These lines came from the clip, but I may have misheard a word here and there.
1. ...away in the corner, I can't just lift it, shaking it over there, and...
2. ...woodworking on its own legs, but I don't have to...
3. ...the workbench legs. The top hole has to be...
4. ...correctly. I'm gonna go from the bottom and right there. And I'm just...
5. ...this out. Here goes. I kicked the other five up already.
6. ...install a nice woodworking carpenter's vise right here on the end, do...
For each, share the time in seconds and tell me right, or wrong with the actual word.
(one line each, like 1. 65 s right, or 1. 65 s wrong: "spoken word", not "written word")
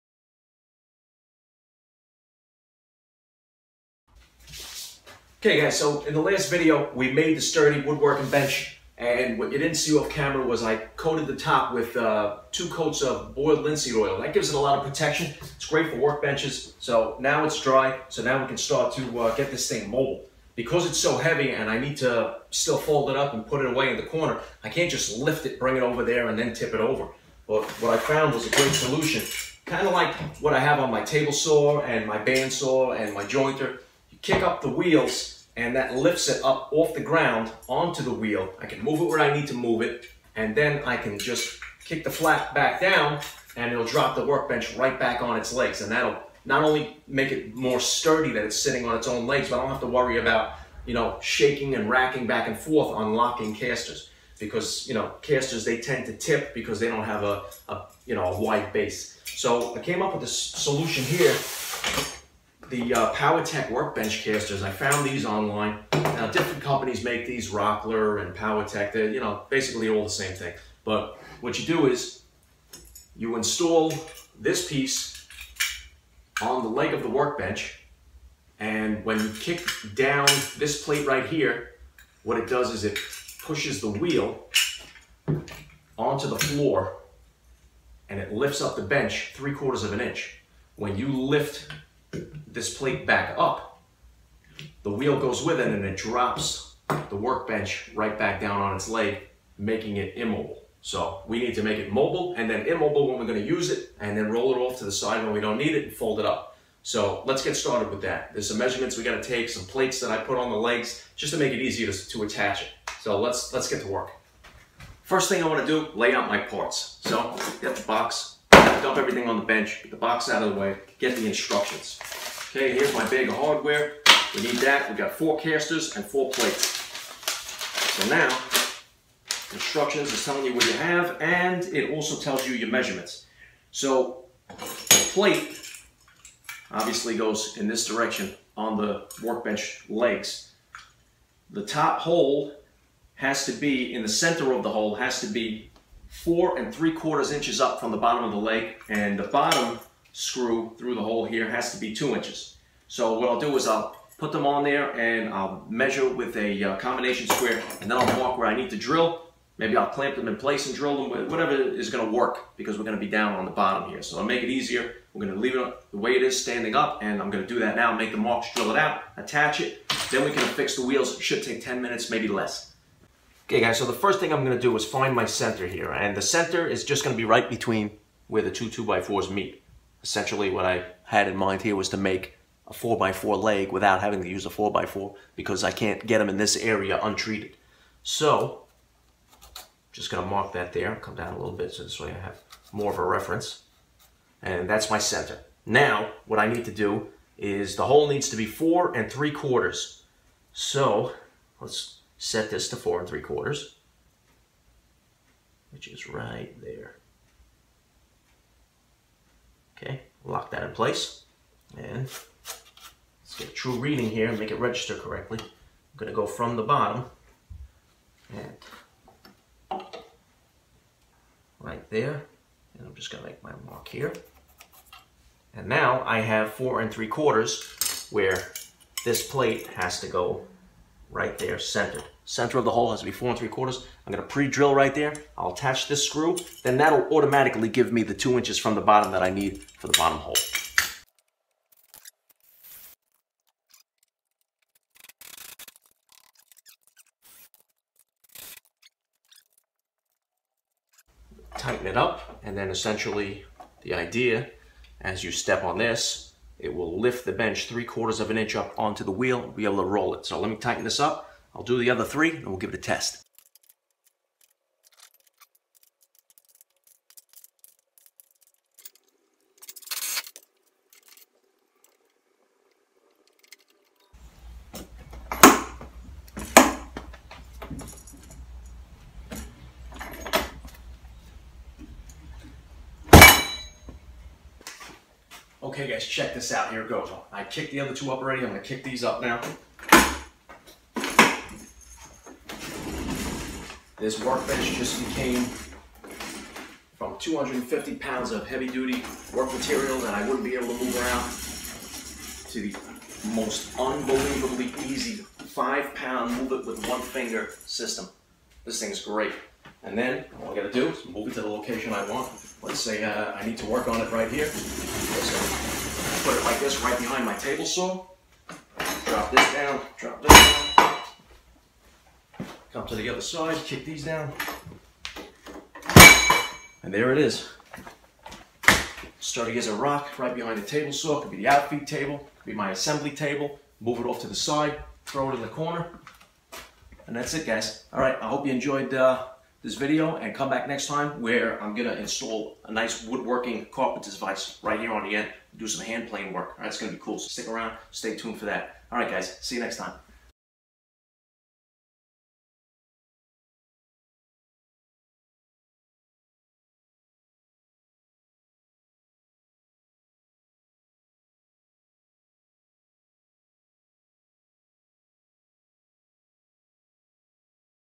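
1. 23 s wrong: "bring", not "shaking"
2. 48 s wrong: "sitting", not "woodworking"
3. 138 s right
4. 214 s right
5. 286 s wrong: "two", not "five"
6. 341 s right.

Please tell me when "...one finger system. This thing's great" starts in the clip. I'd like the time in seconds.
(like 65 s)
306 s.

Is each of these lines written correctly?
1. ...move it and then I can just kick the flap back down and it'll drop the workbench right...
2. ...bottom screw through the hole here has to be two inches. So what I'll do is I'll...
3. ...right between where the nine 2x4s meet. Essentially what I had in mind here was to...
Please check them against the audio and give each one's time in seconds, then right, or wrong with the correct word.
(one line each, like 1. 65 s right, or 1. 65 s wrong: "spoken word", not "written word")
1. 39 s right
2. 149 s right
3. 177 s wrong: "two", not "nine".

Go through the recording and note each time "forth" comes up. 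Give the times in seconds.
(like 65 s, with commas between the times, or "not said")
52 s.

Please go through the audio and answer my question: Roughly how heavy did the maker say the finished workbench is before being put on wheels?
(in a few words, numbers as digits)
250 pounds.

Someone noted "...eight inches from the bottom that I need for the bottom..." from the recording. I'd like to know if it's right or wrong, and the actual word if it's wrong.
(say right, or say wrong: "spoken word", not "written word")
wrong: "two", not "eight".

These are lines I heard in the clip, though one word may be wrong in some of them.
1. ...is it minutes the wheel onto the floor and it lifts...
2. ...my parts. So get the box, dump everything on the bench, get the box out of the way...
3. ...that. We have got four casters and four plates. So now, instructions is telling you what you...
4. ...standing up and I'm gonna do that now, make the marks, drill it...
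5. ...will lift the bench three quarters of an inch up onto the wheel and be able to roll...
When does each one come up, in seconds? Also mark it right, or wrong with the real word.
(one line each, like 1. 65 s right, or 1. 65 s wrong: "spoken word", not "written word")
1. 82 s wrong: "pushes", not "minutes"
2. 116 s right
3. 124 s right
4. 166 s right
5. 256 s right.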